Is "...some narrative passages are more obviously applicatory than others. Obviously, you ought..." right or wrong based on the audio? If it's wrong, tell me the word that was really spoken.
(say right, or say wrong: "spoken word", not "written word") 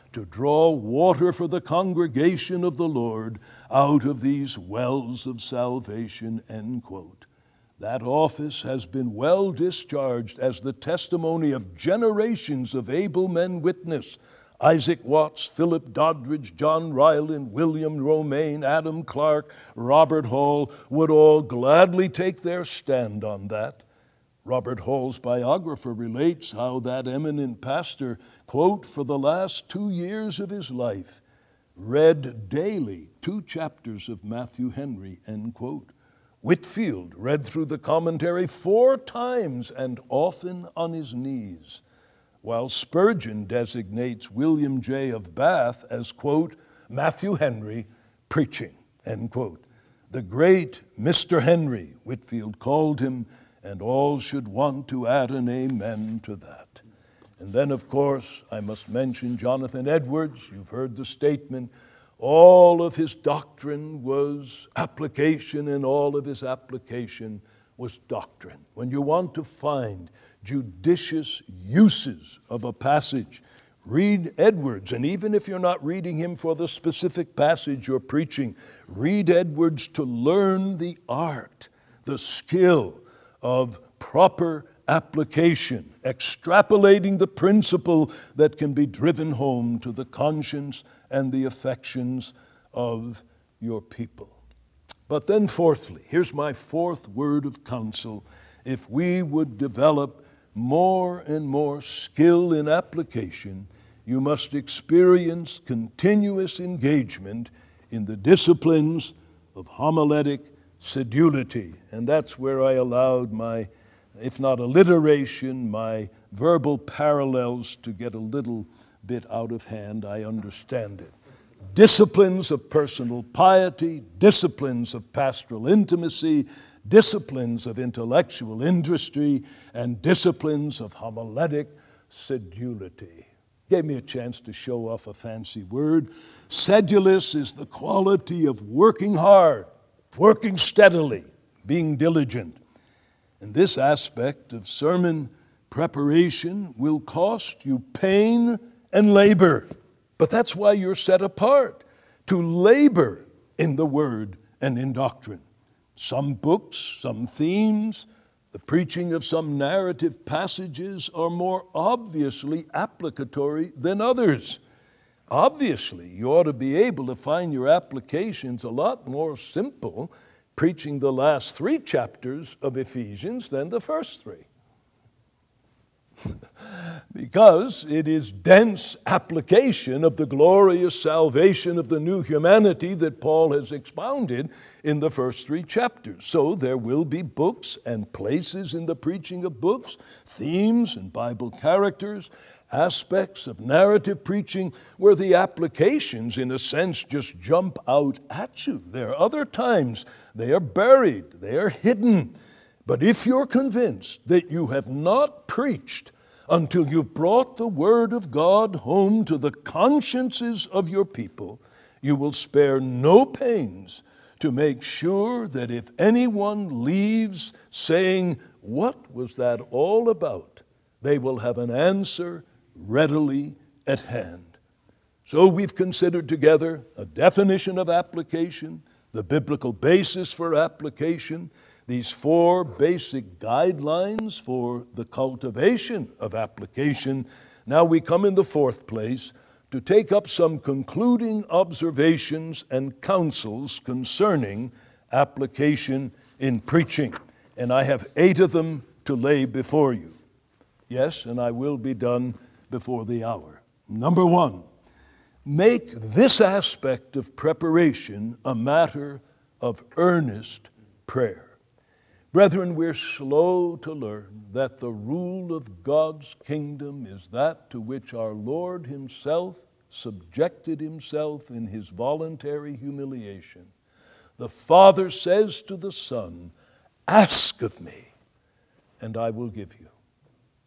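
right.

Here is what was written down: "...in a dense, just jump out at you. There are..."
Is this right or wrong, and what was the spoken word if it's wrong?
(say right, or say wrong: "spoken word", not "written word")
wrong: "sense", not "dense".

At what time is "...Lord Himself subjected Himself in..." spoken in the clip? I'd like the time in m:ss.
4:28.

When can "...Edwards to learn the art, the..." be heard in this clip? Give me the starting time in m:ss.
1:19.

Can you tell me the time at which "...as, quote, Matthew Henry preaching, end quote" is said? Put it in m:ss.
0:45.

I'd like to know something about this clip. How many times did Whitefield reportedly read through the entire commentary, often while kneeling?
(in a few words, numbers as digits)
4.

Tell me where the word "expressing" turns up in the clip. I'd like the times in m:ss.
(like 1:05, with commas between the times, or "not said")
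not said.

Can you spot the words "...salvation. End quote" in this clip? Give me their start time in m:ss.
0:05.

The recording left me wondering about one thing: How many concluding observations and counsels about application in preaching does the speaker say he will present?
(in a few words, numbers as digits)
8.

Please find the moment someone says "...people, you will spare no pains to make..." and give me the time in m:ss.
3:31.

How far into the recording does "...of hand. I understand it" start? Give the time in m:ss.
1:59.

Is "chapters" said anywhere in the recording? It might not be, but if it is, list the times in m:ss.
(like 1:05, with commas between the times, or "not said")
0:33, 2:51, 3:05.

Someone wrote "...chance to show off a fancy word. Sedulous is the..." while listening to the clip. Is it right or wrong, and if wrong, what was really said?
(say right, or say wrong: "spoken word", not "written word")
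right.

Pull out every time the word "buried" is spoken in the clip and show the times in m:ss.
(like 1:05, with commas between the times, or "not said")
3:20.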